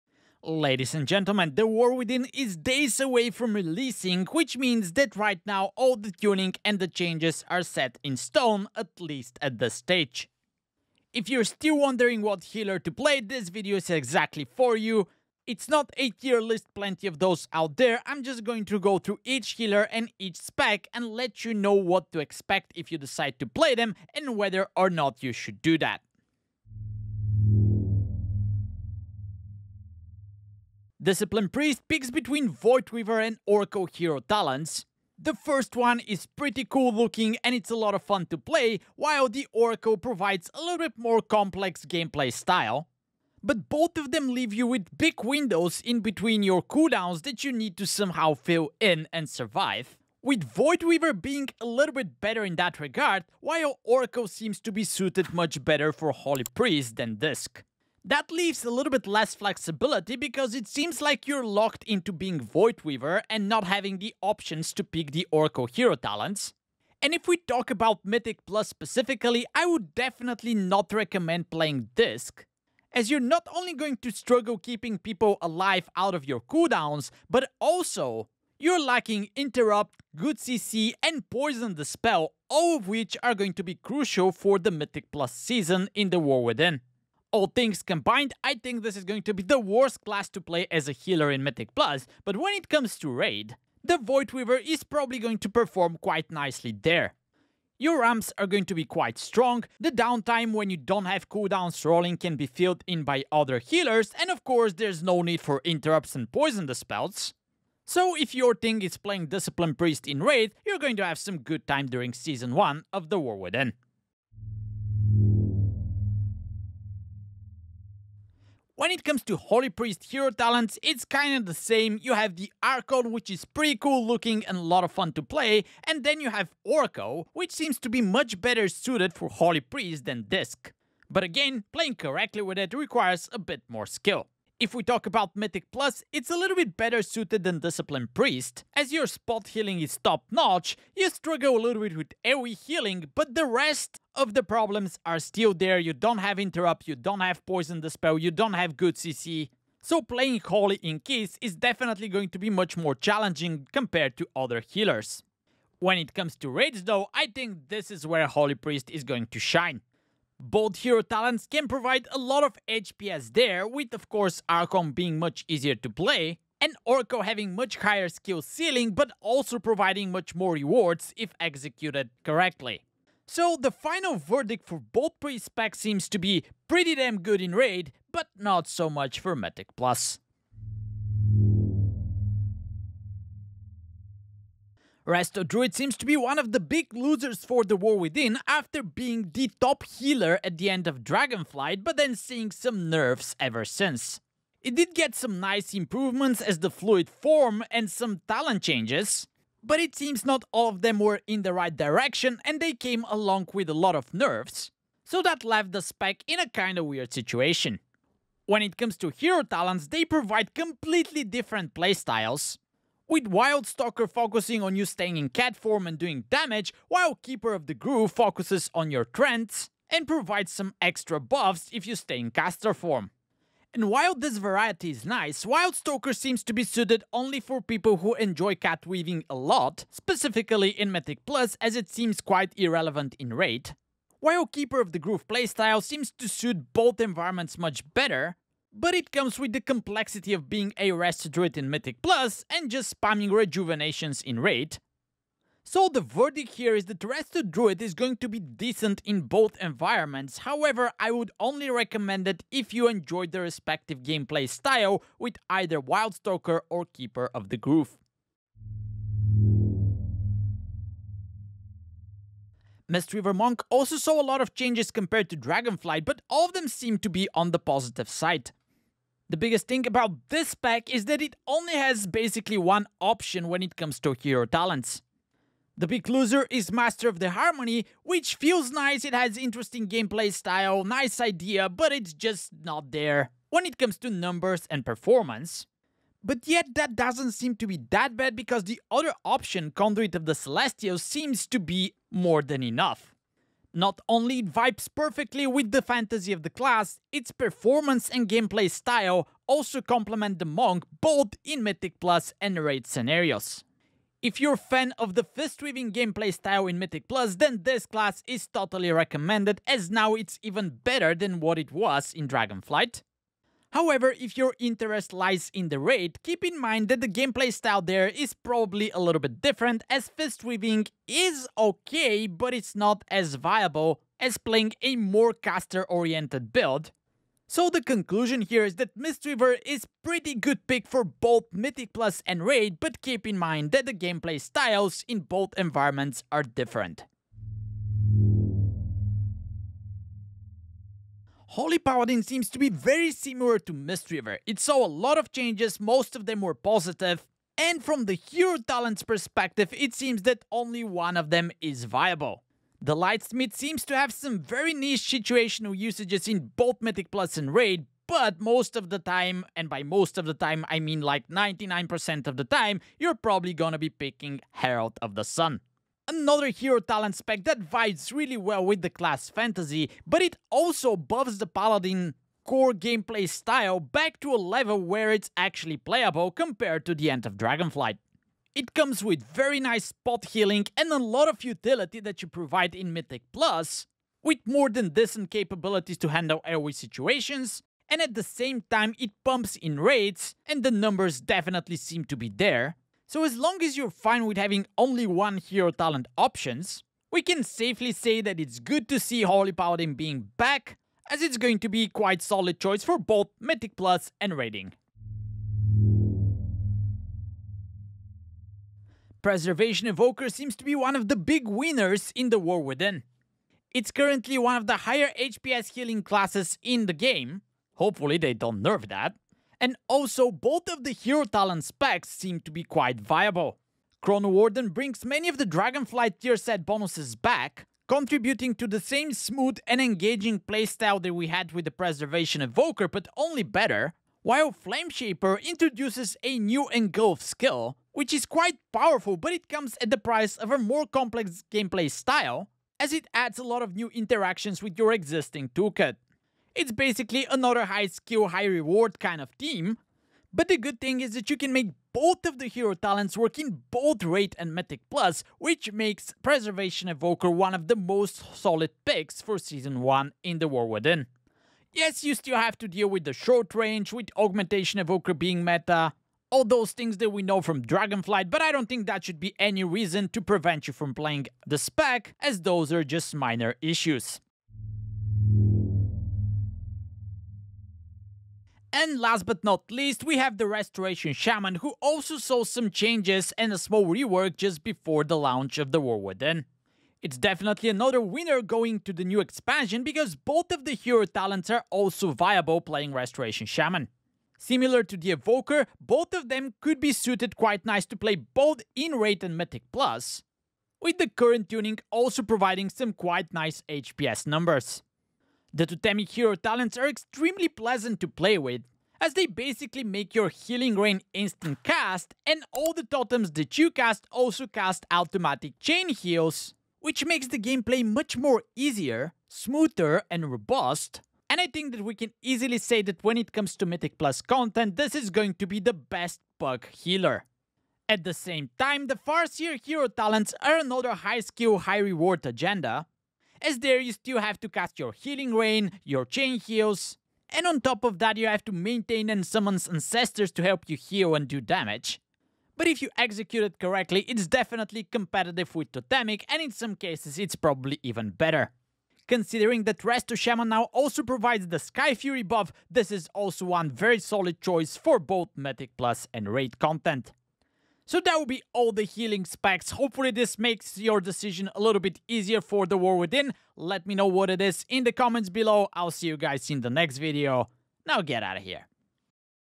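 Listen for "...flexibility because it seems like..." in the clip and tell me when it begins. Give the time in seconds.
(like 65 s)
59 s.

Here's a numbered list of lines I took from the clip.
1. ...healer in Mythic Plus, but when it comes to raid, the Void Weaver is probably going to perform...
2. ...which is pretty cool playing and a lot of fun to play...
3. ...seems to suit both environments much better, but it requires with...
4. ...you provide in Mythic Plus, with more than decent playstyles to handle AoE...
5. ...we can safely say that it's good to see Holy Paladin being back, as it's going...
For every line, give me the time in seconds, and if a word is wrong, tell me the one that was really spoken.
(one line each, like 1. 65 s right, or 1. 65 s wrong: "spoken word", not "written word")
1. 90 s right
2. 123 s wrong: "looking", not "playing"
3. 235 s wrong: "comes", not "requires"
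4. 382 s wrong: "capabilities", not "playstyles"
5. 397 s right.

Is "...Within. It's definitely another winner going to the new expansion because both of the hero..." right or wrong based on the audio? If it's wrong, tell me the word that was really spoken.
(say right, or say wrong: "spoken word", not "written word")
right.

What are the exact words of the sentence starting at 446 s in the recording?
It's basically another high skill, high reward kind of team.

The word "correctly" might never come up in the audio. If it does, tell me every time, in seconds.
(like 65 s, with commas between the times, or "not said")
132 s, 172 s, 543 s.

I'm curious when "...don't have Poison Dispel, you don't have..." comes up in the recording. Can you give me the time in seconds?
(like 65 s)
146 s.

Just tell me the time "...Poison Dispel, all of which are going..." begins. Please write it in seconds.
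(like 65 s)
81 s.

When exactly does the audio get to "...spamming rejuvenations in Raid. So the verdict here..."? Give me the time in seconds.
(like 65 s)
242 s.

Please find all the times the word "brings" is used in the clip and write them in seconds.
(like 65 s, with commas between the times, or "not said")
424 s.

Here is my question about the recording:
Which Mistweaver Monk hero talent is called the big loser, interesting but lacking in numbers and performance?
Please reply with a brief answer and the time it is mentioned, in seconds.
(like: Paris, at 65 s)
Master of the Harmony, at 276 s.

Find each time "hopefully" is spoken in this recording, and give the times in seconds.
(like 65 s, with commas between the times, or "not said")
417 s, 559 s.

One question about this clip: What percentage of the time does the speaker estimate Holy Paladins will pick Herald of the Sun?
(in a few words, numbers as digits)
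99%.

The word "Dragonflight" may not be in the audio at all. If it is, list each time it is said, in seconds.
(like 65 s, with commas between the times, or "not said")
191 s, 265 s, 312 s, 377 s, 425 s, 467 s.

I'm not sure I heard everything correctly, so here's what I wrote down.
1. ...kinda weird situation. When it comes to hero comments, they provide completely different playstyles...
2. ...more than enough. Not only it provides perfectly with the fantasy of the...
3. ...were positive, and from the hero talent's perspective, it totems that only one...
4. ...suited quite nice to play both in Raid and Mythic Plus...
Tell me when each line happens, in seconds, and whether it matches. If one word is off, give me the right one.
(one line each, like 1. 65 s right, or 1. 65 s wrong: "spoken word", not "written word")
1. 206 s wrong: "talents", not "comments"
2. 292 s wrong: "vibes", not "provides"
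3. 346 s wrong: "seems", not "totems"
4. 496 s right.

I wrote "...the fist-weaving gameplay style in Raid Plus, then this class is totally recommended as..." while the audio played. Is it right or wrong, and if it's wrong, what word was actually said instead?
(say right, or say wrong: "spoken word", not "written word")
wrong: "Mythic", not "Raid".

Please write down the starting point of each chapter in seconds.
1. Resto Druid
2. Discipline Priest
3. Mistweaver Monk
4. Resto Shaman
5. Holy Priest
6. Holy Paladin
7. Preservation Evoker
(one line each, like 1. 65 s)
1. 181 s
2. 28 s
3. 259 s
4. 475 s
5. 114 s
6. 338 s
7. 405 s.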